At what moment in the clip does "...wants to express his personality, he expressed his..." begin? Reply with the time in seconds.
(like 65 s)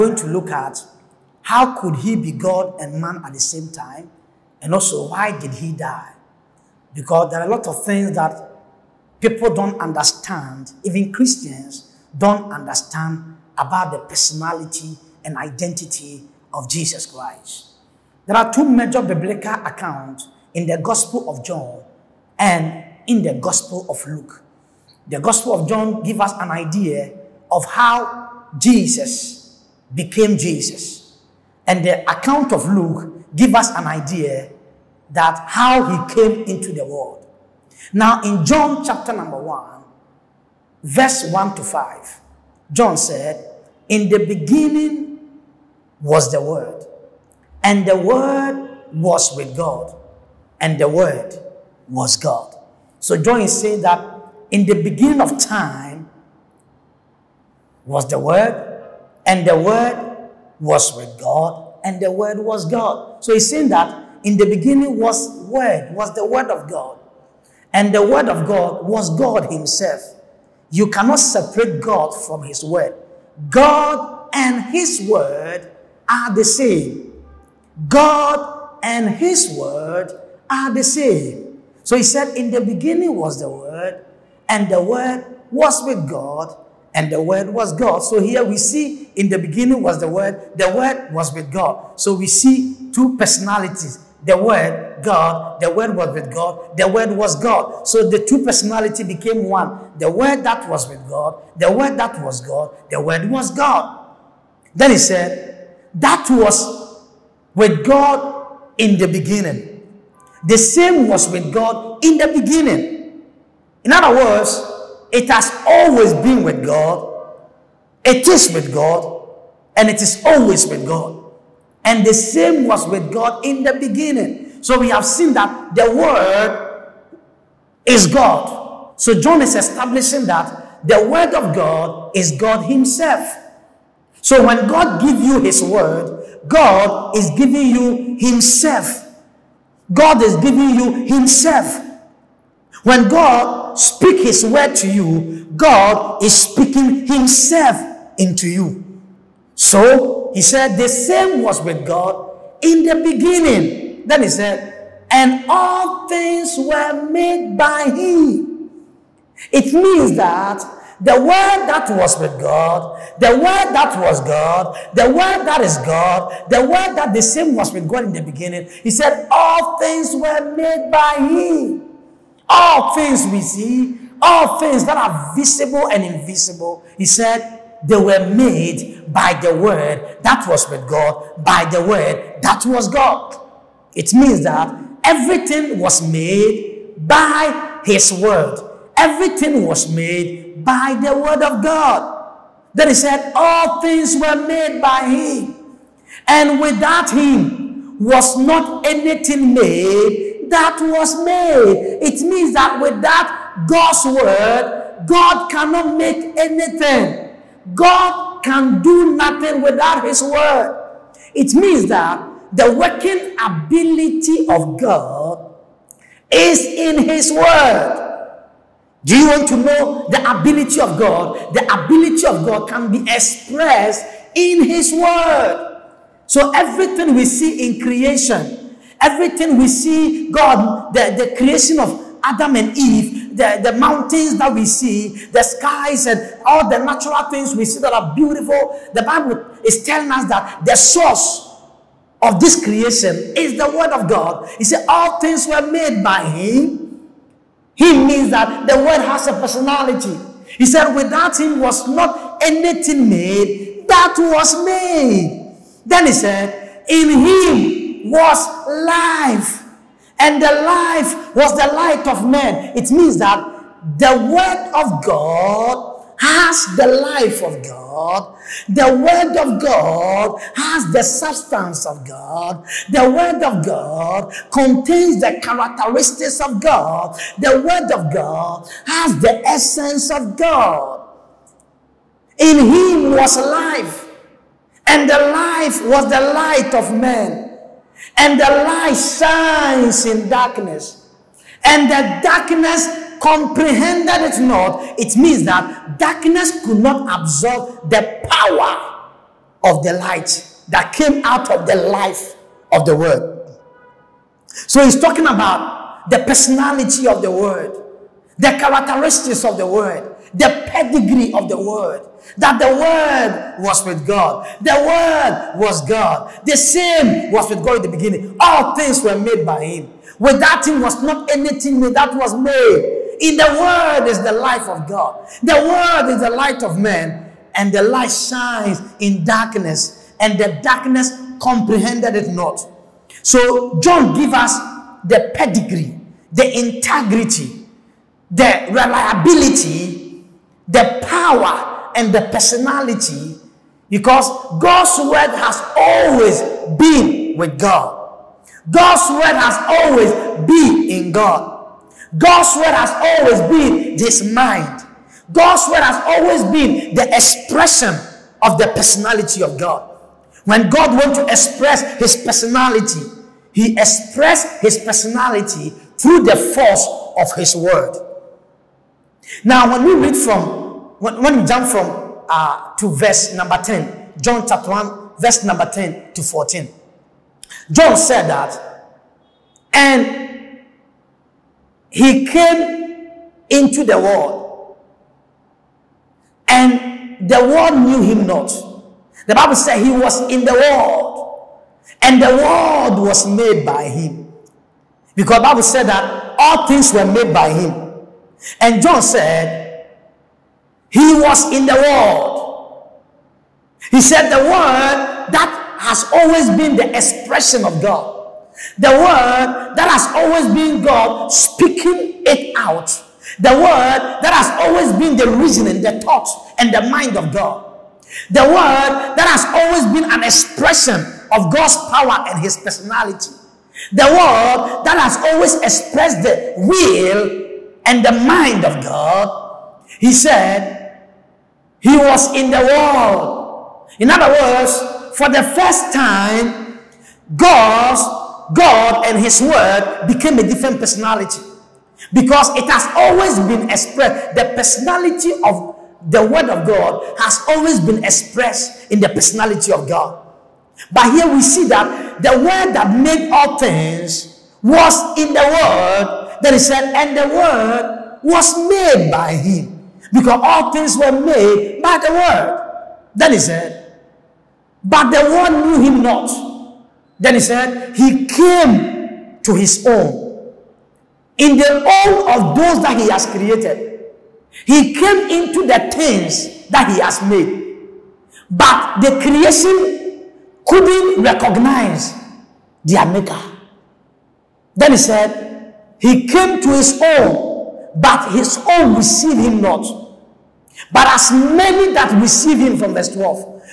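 360 s.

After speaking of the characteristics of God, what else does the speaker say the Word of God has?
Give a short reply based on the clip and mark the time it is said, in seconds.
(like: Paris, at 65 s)
the essence of God, at 279 s.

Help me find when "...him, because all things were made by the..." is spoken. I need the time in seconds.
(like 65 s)
459 s.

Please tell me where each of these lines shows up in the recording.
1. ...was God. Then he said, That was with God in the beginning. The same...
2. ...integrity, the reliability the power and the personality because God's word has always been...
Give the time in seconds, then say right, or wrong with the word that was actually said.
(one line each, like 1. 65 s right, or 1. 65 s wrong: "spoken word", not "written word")
1. 103 s right
2. 336 s right.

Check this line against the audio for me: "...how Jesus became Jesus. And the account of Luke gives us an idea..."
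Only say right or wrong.
right.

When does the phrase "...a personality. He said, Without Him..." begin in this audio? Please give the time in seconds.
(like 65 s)
249 s.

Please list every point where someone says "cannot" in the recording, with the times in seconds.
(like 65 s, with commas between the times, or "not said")
70 s, 205 s.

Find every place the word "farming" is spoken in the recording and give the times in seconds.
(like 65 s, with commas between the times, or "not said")
not said.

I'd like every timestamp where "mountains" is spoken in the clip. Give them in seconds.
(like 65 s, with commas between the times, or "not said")
233 s.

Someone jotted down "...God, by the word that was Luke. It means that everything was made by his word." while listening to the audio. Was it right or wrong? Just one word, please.
wrong.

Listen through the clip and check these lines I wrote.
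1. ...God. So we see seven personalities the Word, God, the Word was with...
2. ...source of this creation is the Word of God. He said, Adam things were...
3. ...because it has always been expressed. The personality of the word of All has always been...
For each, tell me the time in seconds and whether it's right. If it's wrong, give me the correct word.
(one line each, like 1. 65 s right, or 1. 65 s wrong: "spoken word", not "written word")
1. 91 s wrong: "two", not "seven"
2. 240 s wrong: "All", not "Adam"
3. 442 s wrong: "God", not "All".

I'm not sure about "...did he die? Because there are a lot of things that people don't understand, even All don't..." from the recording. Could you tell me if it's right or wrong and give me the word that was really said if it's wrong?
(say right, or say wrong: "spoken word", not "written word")
wrong: "Christians", not "All".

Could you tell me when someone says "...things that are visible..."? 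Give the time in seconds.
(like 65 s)
174 s.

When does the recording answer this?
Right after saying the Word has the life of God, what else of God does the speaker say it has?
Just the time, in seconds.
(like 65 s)
271 s.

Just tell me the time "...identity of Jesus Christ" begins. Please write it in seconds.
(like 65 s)
15 s.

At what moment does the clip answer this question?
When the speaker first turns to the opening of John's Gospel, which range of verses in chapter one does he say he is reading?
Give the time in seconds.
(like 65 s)
41 s.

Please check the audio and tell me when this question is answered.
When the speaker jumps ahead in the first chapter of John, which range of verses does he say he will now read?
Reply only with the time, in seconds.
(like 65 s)
375 s.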